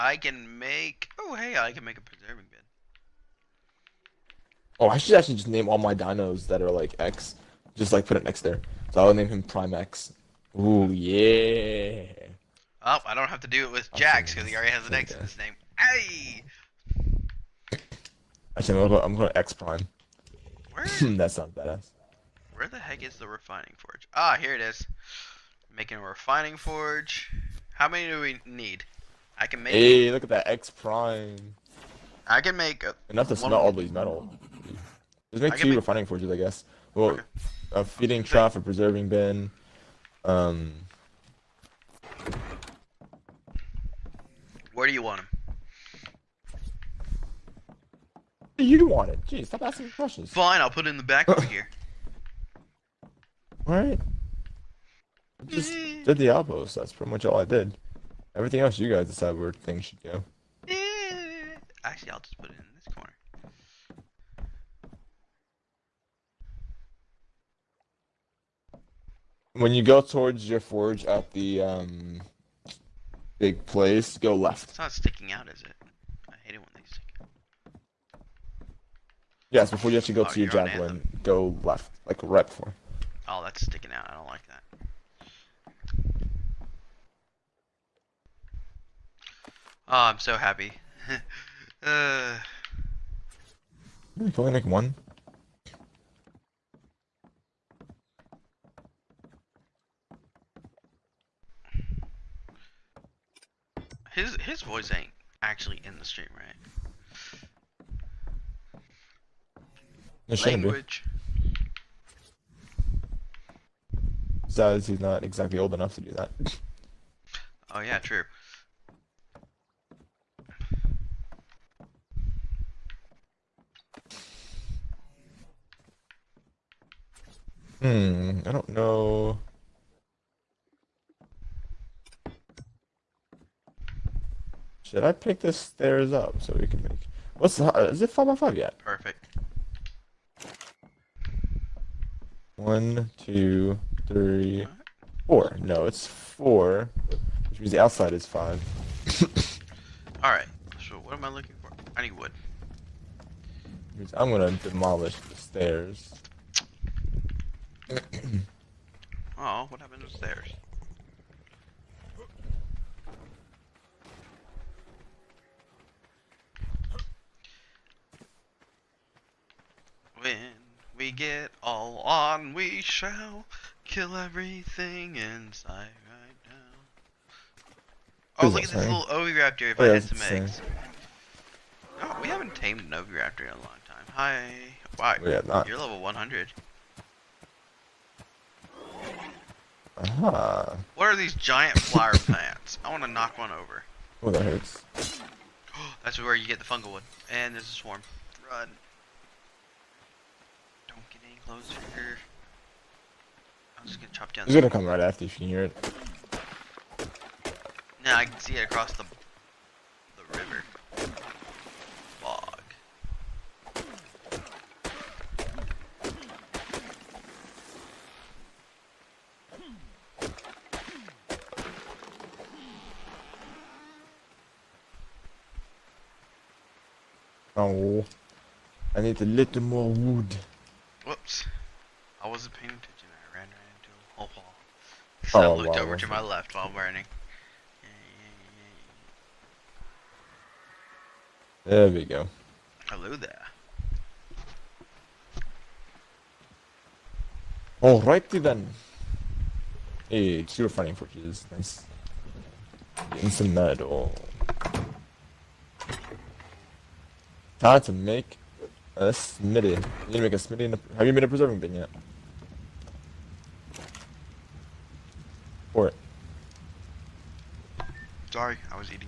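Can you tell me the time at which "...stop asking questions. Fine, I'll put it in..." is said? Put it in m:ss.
0:49.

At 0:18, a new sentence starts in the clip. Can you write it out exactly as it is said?
Actually, I'm gonna, I'm gonna X Prime.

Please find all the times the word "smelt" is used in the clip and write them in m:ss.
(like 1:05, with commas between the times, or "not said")
0:33.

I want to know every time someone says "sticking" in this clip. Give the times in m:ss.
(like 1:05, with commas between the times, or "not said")
1:14, 1:23.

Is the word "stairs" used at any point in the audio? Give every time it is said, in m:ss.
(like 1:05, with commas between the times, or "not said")
2:15, 2:35, 2:40.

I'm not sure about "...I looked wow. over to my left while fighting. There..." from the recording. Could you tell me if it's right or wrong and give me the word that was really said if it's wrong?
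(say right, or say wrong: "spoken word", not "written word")
wrong: "burning", not "fighting".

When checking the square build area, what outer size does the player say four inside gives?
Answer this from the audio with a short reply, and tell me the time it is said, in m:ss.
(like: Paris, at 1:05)
5, at 2:28.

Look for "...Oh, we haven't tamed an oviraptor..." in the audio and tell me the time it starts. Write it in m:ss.
3:02.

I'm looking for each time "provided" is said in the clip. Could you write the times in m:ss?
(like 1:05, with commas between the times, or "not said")
not said.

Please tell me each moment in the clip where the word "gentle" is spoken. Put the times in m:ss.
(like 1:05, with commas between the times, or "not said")
not said.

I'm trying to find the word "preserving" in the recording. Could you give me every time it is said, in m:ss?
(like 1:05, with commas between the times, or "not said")
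0:02, 0:38, 4:21.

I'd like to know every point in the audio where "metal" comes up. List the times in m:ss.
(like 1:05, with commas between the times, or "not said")
0:33, 4:13.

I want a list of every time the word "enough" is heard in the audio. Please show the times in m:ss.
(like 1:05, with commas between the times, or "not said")
0:33, 1:55.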